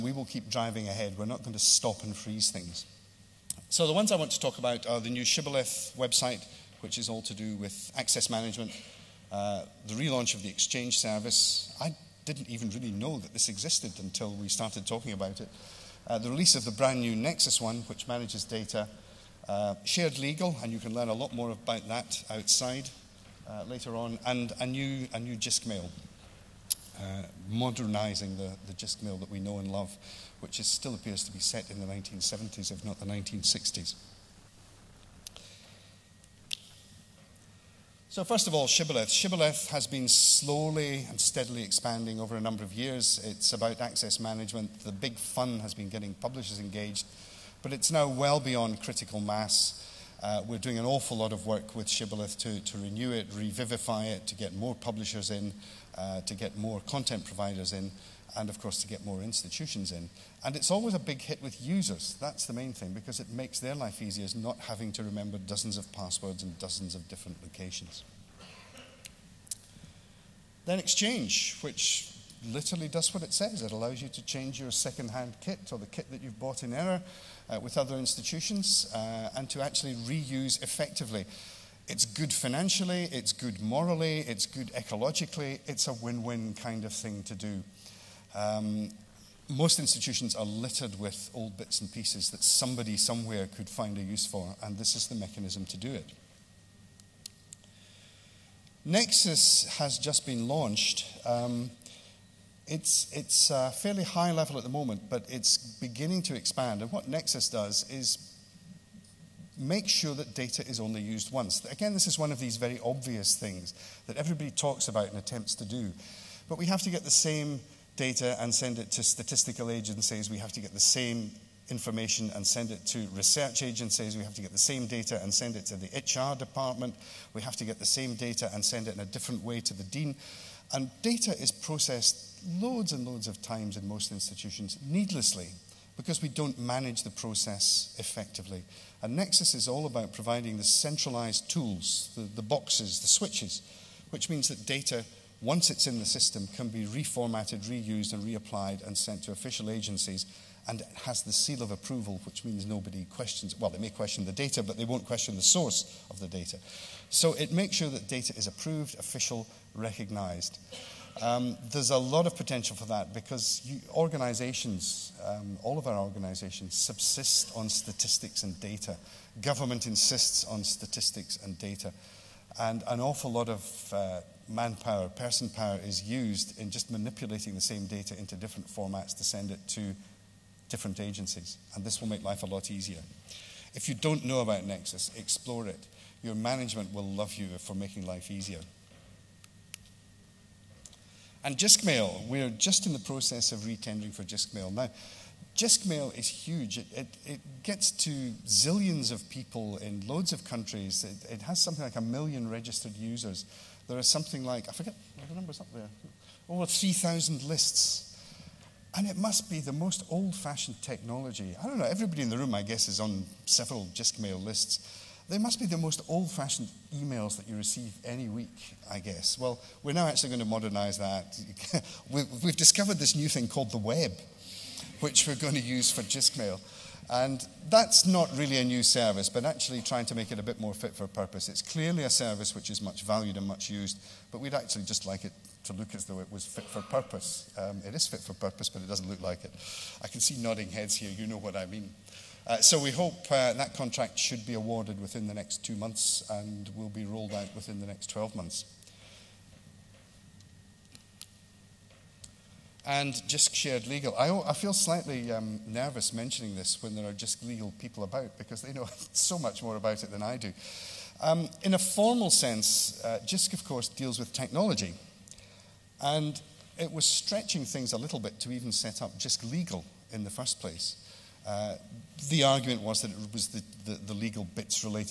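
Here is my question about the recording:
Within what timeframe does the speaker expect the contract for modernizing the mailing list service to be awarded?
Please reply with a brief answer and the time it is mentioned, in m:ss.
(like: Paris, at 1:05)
next 2 months, at 4:05.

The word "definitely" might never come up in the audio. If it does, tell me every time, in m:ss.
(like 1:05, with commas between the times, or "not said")
not said.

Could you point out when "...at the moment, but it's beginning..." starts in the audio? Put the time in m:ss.
1:44.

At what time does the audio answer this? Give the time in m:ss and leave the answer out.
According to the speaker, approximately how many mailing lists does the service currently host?
3:26.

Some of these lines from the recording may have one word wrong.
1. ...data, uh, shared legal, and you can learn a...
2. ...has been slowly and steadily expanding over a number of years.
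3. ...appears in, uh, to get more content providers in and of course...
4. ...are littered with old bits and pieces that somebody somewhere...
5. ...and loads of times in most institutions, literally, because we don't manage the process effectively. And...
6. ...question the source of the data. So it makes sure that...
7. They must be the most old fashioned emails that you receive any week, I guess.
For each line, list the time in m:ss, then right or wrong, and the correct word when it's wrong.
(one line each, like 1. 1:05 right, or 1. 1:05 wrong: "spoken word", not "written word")
1. 0:18 right
2. 0:39 right
3. 0:54 wrong: "publishers", not "appears"
4. 1:30 right
5. 2:12 wrong: "needlessly", not "literally"
6. 2:35 right
7. 3:35 right.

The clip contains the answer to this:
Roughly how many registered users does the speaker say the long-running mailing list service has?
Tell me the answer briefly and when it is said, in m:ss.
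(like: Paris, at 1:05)
1 million, at 3:21.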